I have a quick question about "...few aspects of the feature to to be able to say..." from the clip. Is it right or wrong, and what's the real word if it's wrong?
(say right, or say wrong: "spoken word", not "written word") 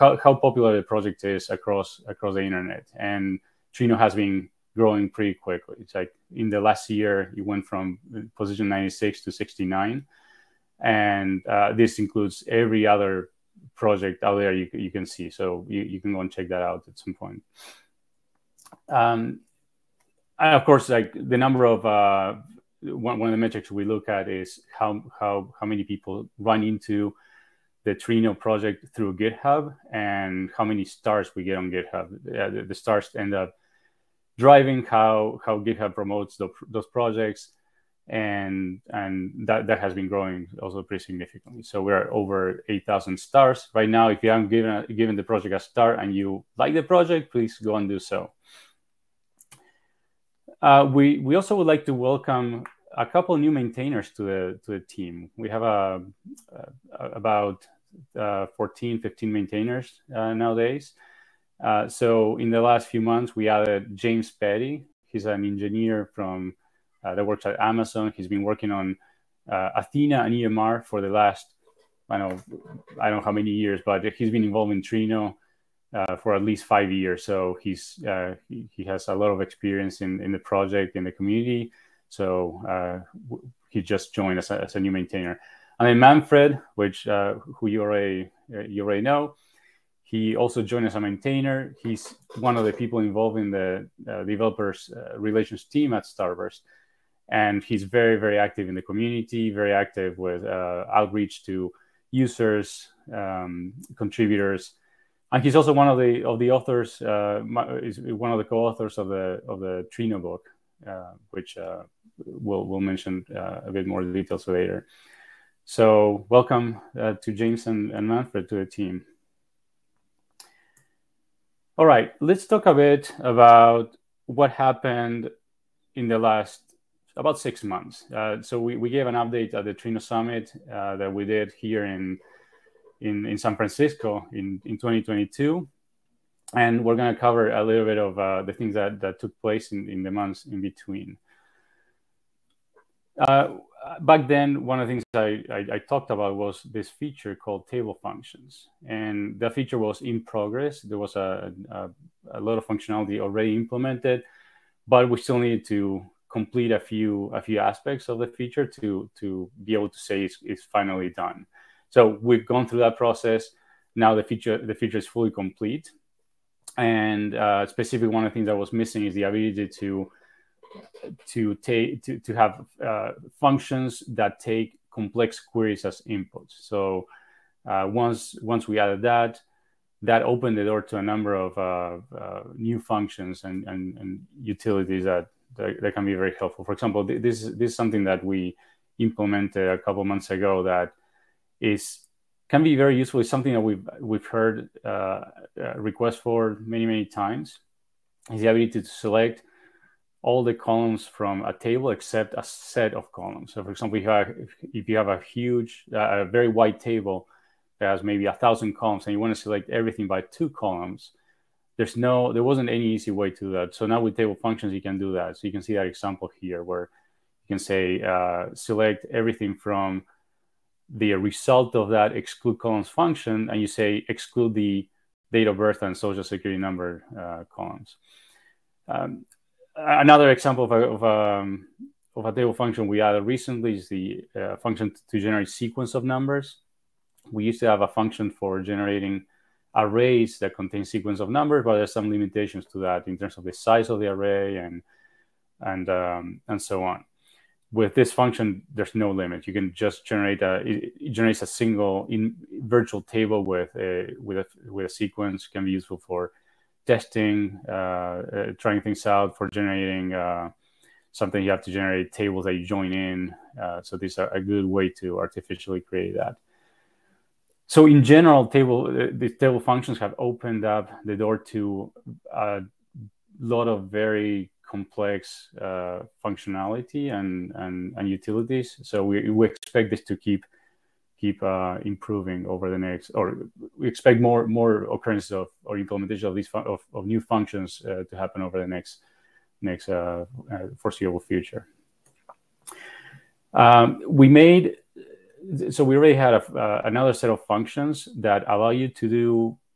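right.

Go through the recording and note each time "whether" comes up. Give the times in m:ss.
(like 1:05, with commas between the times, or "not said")
not said.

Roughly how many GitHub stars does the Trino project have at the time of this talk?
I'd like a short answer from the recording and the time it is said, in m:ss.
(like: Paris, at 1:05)
over 8000, at 0:42.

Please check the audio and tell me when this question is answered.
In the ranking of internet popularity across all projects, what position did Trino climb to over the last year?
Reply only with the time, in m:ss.
0:09.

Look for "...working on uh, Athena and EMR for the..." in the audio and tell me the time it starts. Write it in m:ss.
1:08.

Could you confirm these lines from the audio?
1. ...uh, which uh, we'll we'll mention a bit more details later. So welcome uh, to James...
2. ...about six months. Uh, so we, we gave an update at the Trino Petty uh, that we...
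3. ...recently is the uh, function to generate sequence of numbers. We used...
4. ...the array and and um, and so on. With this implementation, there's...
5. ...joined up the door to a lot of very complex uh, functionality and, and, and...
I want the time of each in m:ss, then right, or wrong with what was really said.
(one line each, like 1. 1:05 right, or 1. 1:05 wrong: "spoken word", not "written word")
1. 1:50 right
2. 2:07 wrong: "Summit", not "Petty"
3. 3:53 right
4. 4:04 wrong: "function", not "implementation"
5. 4:30 wrong: "opened", not "joined".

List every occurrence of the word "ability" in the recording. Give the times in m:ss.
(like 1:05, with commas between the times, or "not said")
2:49, 3:18.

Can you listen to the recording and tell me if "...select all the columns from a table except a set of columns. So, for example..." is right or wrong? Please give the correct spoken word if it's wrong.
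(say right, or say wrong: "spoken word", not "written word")
right.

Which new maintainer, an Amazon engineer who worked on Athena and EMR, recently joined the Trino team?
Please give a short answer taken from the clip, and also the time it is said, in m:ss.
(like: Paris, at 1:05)
James Petty, at 1:03.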